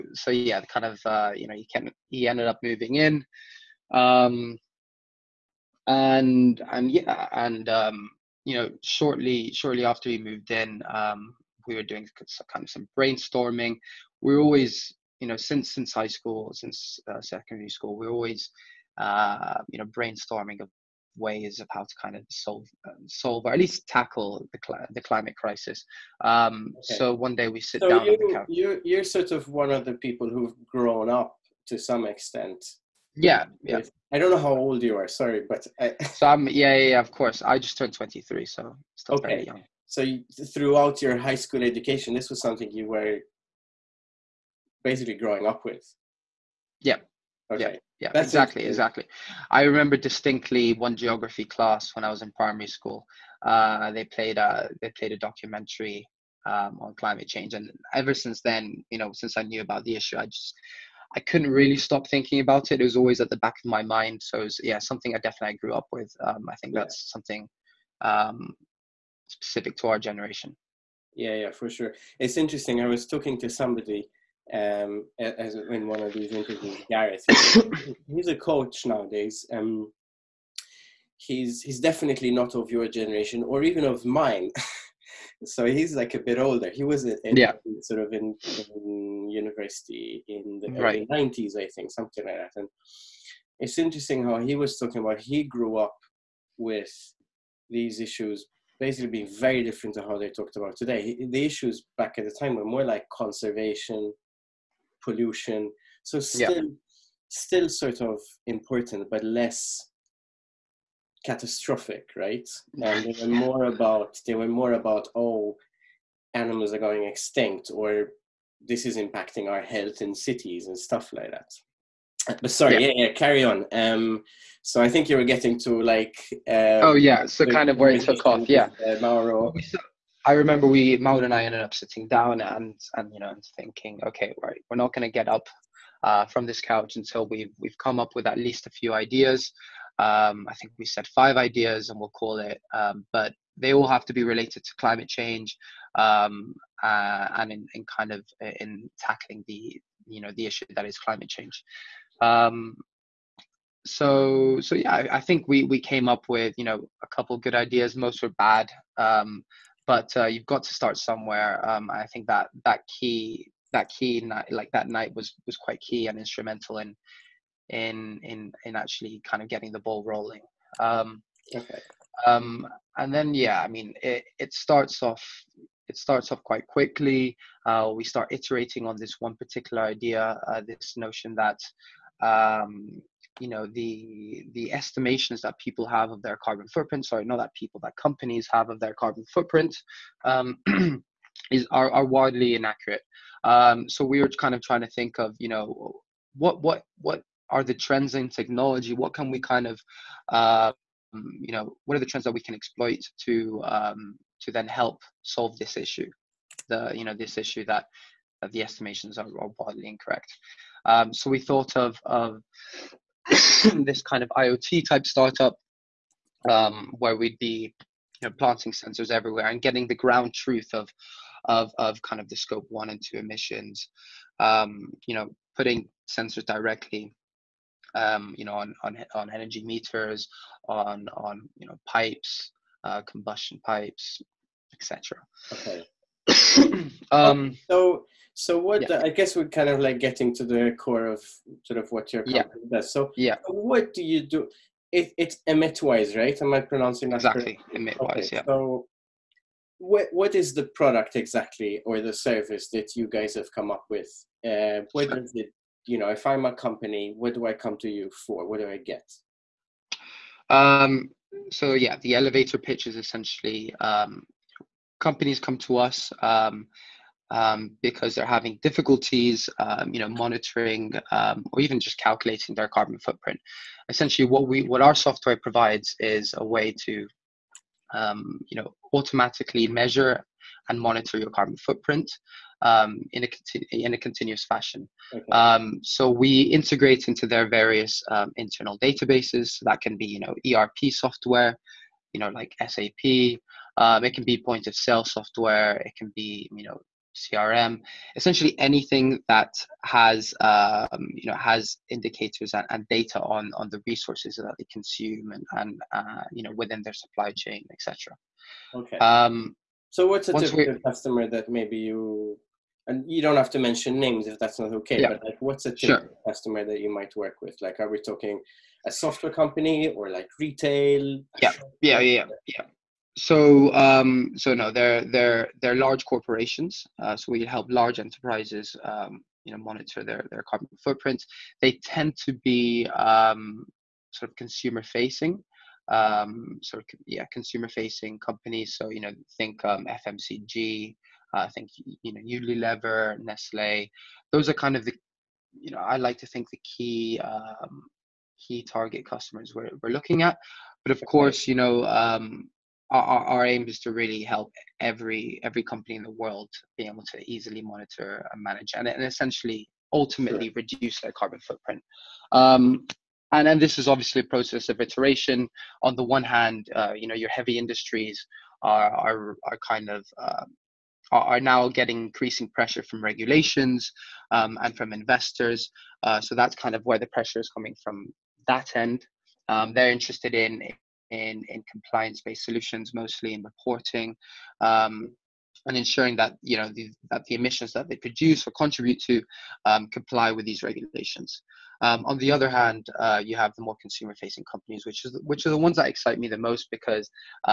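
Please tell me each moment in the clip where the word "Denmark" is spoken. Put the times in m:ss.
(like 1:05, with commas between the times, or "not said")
not said.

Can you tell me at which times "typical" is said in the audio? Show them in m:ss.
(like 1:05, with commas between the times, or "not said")
5:10, 5:15.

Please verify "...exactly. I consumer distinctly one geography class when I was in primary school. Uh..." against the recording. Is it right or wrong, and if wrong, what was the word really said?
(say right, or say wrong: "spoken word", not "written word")
wrong: "remember", not "consumer".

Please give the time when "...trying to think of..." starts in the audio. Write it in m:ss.
3:14.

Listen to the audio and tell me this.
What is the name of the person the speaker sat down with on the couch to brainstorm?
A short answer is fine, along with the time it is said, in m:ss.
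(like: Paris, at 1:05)
Mauro, at 2:10.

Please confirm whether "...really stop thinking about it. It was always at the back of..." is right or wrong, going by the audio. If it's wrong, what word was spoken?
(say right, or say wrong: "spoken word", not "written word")
right.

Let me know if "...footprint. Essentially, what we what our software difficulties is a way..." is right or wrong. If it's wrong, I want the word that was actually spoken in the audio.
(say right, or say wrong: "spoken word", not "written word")
wrong: "provides", not "difficulties".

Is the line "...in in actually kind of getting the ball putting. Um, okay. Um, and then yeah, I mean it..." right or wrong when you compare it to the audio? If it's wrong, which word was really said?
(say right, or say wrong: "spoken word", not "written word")
wrong: "rolling", not "putting".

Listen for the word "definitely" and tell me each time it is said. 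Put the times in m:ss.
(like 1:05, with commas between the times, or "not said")
1:05, 1:21.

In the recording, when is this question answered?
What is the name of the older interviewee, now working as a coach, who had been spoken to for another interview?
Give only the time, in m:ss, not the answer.
1:16.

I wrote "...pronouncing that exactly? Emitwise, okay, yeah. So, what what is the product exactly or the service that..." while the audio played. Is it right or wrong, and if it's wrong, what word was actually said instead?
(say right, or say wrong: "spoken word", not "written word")
right.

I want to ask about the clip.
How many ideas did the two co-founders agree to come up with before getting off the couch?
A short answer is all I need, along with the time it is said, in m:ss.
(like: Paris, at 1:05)
5, at 2:21.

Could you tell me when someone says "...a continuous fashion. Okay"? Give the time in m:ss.
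4:43.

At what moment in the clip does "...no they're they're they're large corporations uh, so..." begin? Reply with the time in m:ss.
5:24.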